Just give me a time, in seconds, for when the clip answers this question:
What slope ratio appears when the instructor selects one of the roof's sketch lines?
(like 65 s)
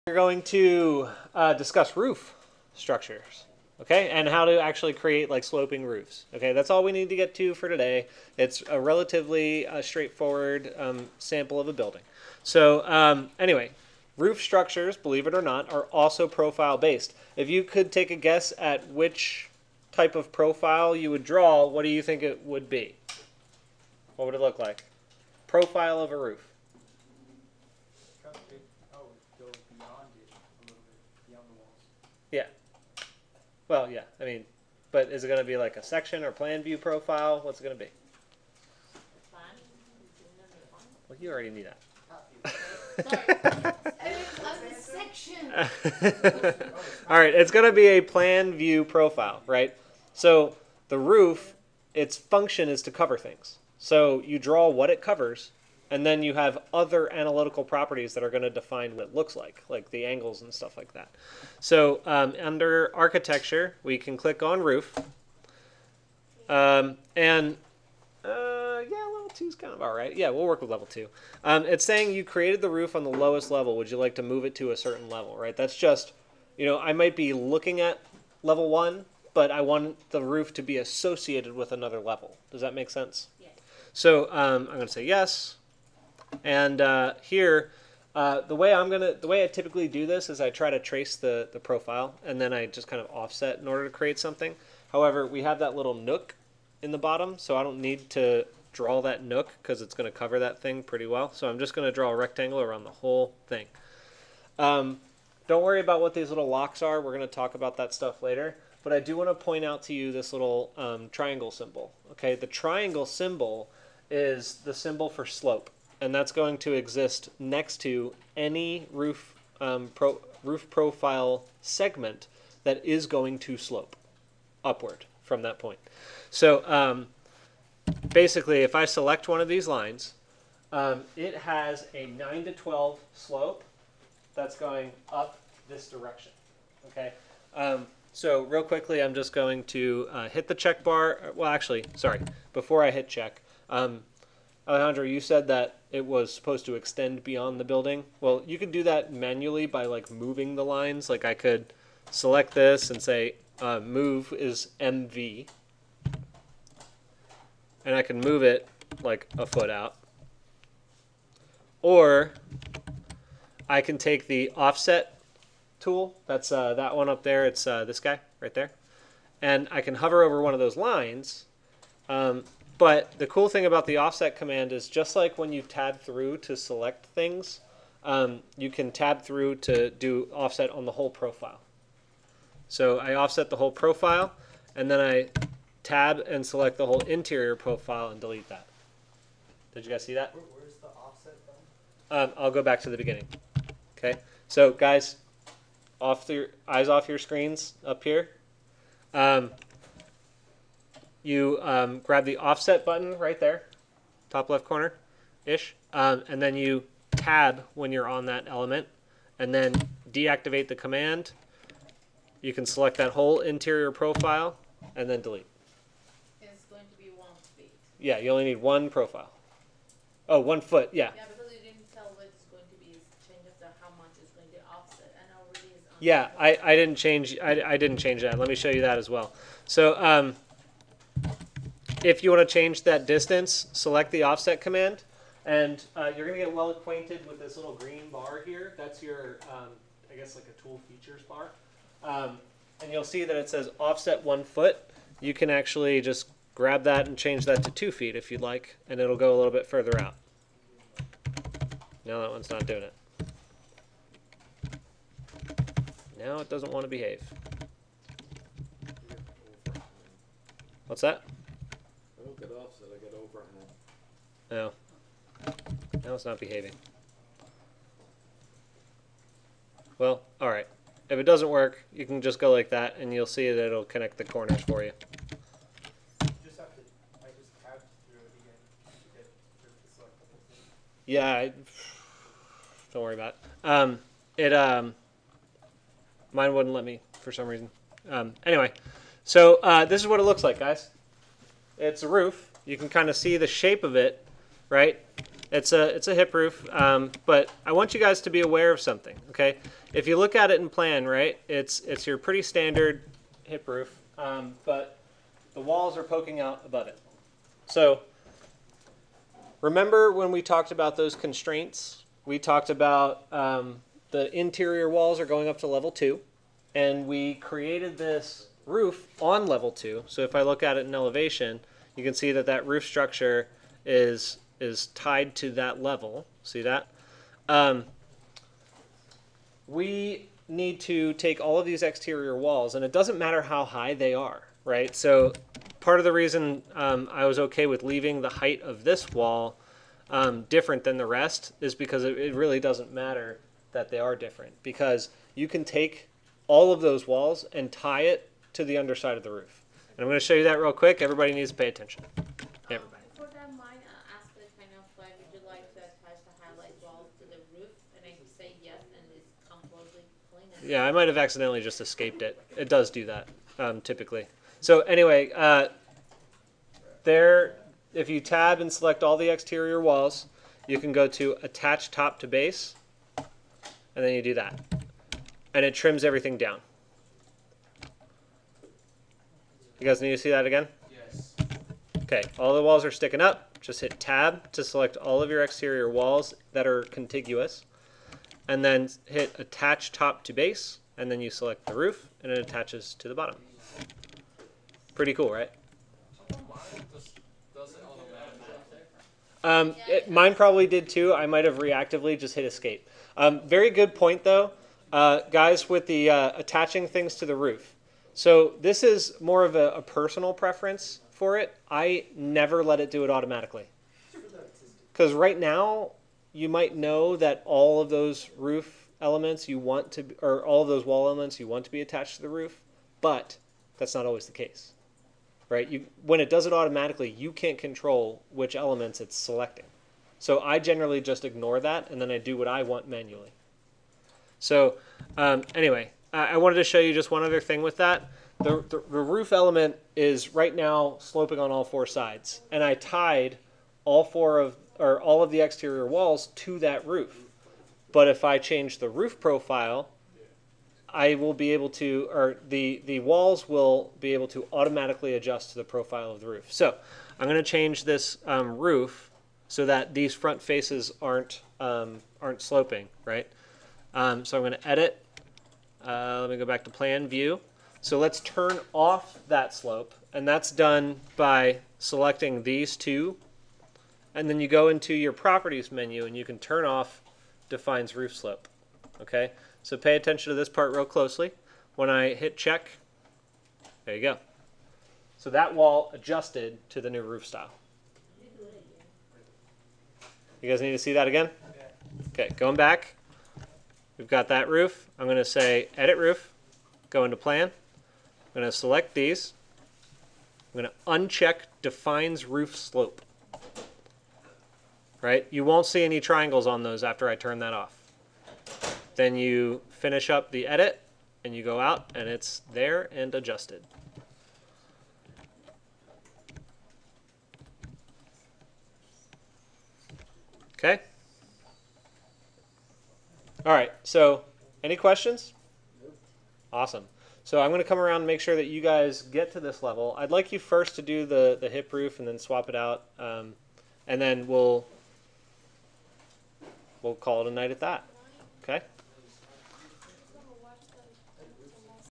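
132 s.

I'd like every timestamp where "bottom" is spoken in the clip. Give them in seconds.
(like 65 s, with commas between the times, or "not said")
96 s, 393 s.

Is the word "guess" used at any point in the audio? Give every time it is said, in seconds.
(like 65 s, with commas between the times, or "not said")
18 s, 240 s.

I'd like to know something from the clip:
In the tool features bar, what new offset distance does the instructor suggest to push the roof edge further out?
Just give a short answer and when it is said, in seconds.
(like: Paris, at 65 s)
2 feet, at 247 s.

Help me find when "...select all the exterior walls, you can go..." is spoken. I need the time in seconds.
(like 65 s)
368 s.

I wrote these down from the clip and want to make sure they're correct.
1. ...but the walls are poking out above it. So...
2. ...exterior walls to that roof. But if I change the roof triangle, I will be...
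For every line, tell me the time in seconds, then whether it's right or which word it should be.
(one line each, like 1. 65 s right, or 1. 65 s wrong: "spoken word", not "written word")
1. 304 s right
2. 445 s wrong: "profile", not "triangle".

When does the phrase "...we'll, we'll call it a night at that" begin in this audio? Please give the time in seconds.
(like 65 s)
534 s.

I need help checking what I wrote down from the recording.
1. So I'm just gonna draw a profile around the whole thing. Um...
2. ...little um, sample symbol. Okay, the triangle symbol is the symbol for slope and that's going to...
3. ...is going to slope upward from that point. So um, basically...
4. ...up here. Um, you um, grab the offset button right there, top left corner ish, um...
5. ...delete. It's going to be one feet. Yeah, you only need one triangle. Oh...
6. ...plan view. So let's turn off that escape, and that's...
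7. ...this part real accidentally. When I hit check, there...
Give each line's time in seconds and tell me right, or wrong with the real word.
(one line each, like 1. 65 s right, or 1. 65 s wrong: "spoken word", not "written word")
1. 101 s wrong: "rectangle", not "profile"
2. 110 s wrong: "triangle", not "sample"
3. 122 s right
4. 197 s right
5. 215 s wrong: "profile", not "triangle"
6. 466 s wrong: "slope", not "escape"
7. 480 s wrong: "closely", not "accidentally".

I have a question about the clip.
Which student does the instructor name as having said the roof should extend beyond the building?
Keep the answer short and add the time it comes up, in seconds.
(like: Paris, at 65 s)
Alejandro, at 144 s.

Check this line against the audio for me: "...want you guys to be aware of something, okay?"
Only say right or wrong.
right.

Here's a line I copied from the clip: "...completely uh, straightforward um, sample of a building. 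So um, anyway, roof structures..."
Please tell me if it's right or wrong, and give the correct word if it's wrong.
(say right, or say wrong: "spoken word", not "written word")
wrong: "relatively", not "completely".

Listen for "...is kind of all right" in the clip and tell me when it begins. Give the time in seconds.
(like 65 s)
69 s.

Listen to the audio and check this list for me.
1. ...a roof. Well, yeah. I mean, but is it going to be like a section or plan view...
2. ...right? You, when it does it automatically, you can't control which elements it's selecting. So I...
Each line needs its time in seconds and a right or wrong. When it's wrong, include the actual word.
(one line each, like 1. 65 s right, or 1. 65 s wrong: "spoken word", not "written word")
1. 26 s right
2. 425 s right.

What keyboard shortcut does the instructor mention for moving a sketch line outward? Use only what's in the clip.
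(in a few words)
MV.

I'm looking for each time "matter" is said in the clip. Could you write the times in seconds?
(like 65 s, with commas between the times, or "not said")
333 s, 342 s.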